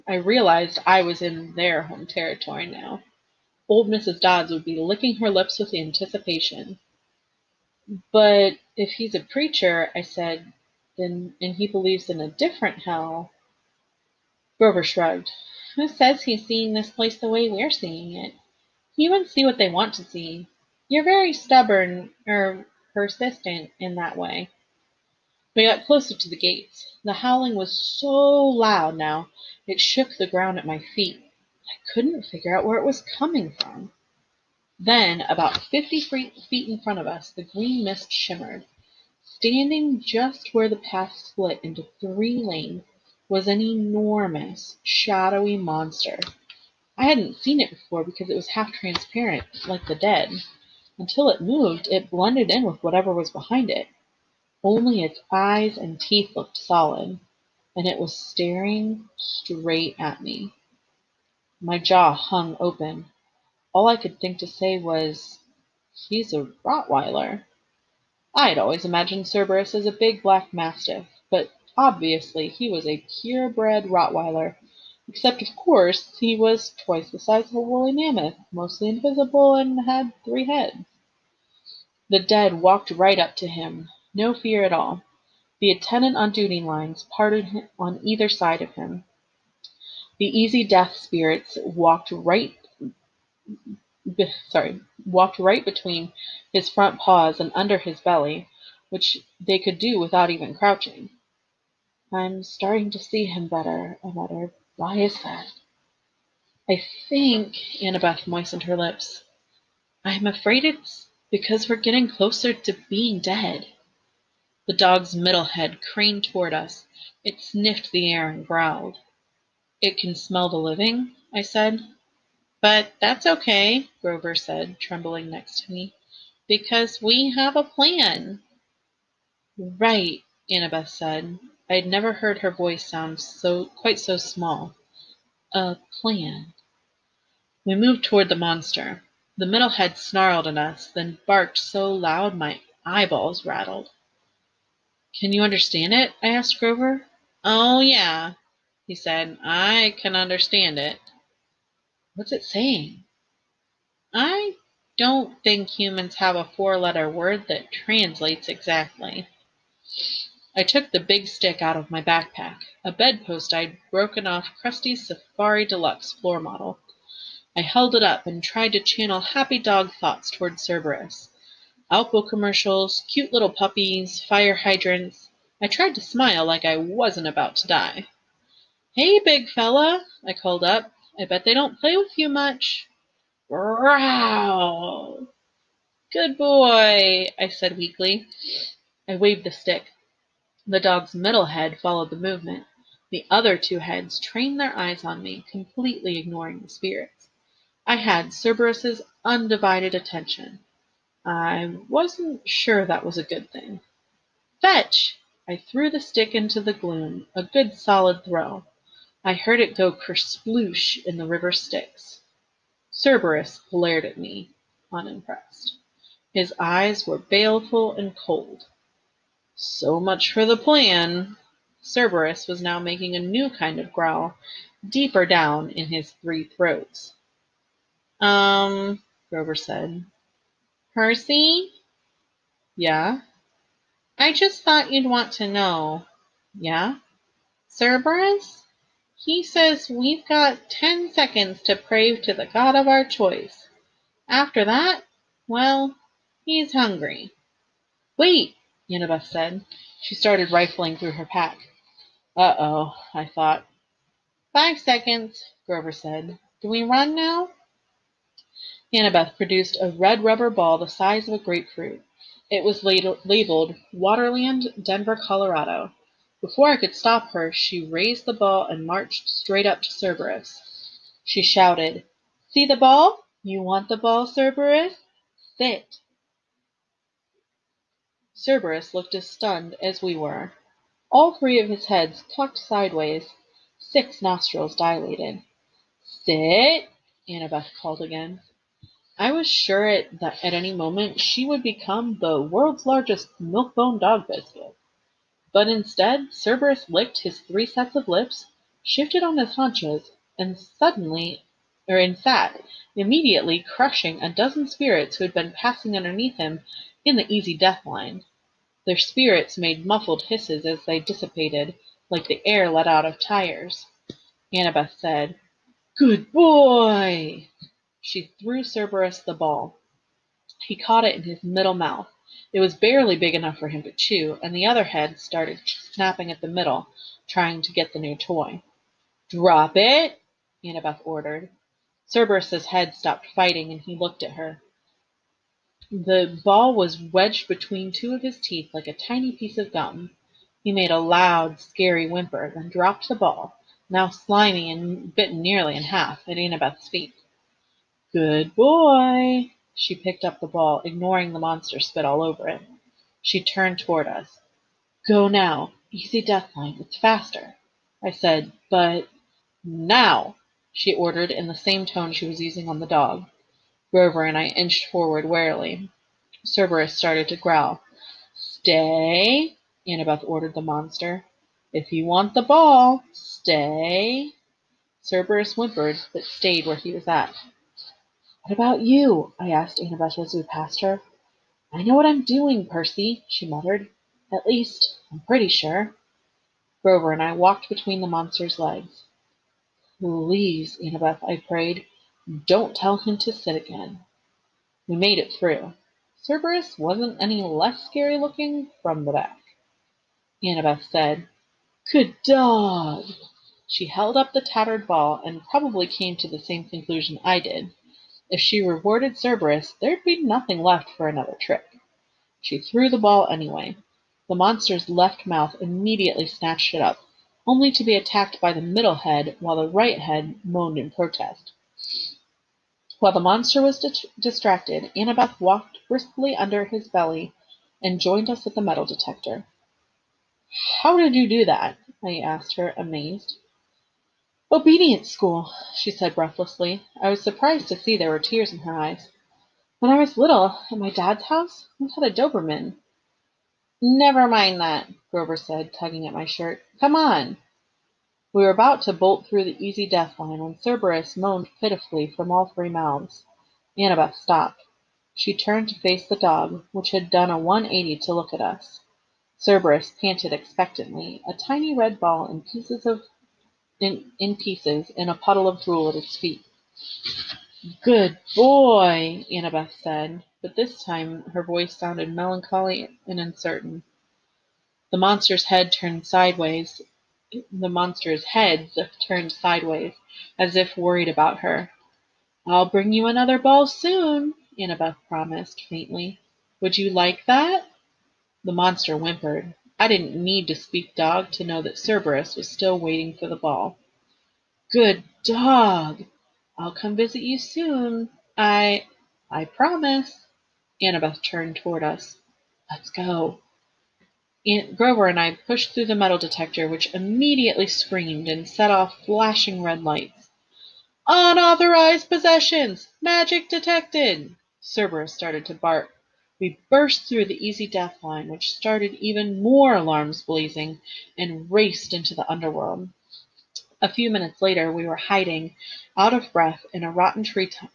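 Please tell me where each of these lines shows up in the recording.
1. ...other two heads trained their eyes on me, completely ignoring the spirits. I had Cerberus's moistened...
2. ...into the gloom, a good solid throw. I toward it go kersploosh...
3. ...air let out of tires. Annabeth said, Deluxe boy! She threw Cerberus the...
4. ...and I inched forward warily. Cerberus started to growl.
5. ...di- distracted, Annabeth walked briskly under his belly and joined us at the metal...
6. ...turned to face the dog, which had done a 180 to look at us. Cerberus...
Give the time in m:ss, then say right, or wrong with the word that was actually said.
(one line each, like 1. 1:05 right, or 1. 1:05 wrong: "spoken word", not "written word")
1. 3:13 wrong: "undivided", not "moistened"
2. 3:26 wrong: "heard", not "toward"
3. 5:12 wrong: "Good", not "Deluxe"
4. 6:04 right
5. 7:03 right
6. 7:35 right.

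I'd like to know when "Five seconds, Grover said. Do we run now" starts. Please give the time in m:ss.
4:14.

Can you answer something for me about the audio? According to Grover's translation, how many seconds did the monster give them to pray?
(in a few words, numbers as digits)
10.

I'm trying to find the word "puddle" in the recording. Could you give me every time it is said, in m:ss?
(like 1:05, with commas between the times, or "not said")
7:45.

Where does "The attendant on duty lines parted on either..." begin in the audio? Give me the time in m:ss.
1:25.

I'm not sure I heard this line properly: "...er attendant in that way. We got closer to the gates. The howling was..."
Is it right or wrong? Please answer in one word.
wrong.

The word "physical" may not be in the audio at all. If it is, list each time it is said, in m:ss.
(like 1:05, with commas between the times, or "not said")
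not said.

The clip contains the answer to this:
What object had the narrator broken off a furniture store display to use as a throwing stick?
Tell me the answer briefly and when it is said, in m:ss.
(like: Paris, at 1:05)
A bedpost, at 2:42.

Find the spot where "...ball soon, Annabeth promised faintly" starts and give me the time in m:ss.
8:03.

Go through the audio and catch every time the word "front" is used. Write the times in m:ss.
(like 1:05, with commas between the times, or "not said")
0:36, 1:36.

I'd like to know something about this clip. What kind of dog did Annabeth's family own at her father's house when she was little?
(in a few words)
Doberman.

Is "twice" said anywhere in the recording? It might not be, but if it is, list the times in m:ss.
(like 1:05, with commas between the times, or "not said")
1:16.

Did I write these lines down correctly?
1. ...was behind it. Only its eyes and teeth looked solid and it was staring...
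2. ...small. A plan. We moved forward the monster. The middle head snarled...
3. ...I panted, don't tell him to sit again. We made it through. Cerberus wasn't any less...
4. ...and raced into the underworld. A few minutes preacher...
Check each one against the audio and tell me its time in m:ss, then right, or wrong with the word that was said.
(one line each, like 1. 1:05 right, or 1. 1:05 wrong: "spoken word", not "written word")
1. 0:53 right
2. 2:14 wrong: "toward", not "forward"
3. 6:31 wrong: "prayed", not "panted"
4. 8:41 wrong: "later", not "preacher".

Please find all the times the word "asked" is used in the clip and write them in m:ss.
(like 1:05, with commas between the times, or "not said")
2:26, 6:19, 7:12.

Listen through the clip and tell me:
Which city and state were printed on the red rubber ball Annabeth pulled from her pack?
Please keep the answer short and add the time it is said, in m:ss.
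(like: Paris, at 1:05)
Denver, Colorado, at 4:24.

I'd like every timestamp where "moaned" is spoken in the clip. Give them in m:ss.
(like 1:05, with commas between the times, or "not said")
7:00, 7:31.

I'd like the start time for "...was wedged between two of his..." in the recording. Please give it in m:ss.
5:36.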